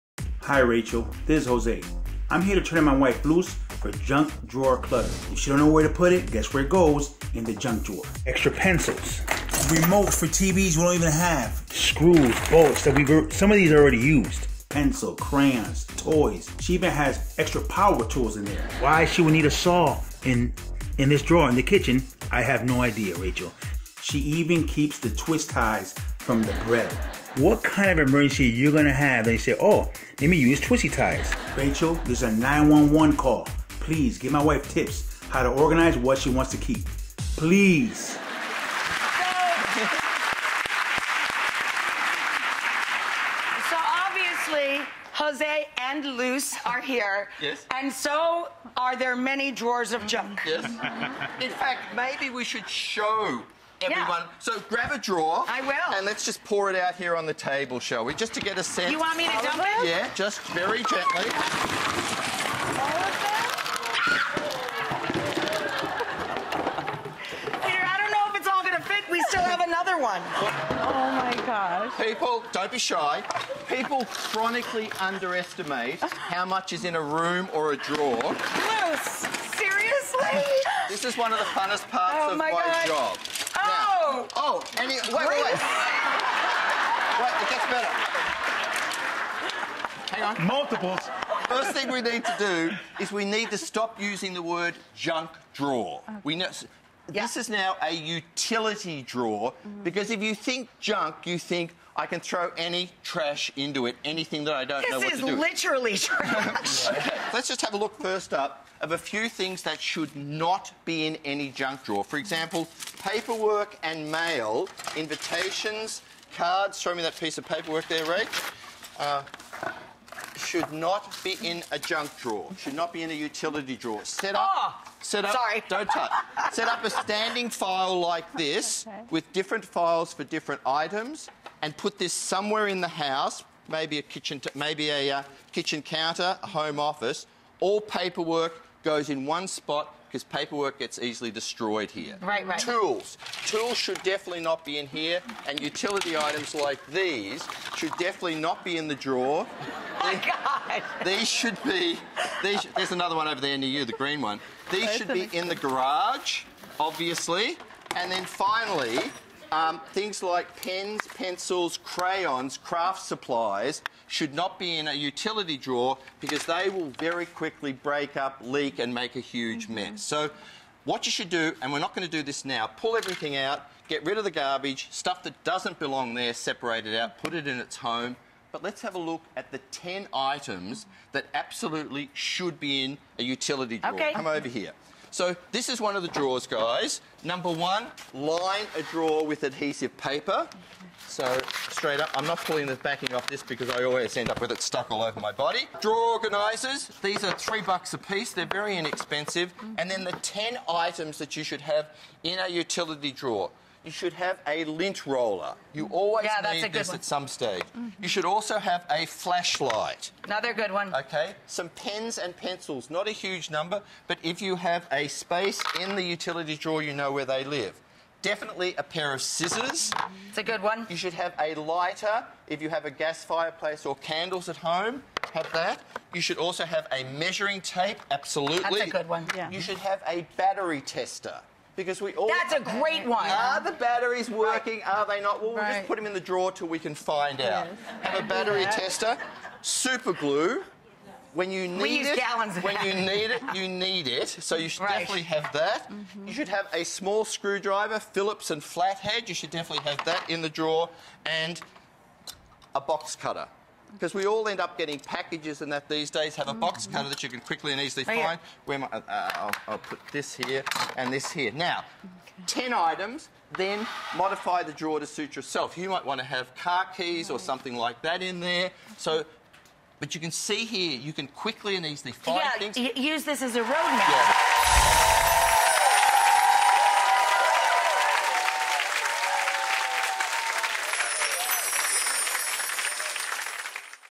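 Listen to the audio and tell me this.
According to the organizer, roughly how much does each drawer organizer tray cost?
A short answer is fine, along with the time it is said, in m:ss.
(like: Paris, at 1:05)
3 dollars, at 3:17.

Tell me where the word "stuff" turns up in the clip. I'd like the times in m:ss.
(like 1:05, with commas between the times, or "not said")
2:54.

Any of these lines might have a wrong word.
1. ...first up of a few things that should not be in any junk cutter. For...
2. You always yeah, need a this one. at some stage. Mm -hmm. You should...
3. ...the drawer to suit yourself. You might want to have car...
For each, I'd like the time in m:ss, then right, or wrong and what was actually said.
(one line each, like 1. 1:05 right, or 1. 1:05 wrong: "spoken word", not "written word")
1. 1:48 wrong: "drawer", not "cutter"
2. 3:25 right
3. 4:24 right.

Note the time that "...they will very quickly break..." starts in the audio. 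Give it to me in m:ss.
2:46.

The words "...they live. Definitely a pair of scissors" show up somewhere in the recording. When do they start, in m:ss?
3:37.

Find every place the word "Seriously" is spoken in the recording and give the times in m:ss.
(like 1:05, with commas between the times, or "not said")
1:19.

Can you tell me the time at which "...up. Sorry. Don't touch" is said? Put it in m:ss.
2:05.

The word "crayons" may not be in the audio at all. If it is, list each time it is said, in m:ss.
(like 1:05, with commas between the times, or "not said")
0:15, 2:41.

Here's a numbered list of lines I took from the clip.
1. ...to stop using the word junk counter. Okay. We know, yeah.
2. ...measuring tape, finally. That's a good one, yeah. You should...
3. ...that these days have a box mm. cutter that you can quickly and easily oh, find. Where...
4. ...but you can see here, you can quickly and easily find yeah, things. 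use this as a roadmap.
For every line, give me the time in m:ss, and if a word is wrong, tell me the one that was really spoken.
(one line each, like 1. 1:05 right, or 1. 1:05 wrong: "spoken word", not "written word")
1. 1:33 wrong: "drawer", not "counter"
2. 3:47 wrong: "absolutely", not "finally"
3. 4:15 right
4. 4:29 right.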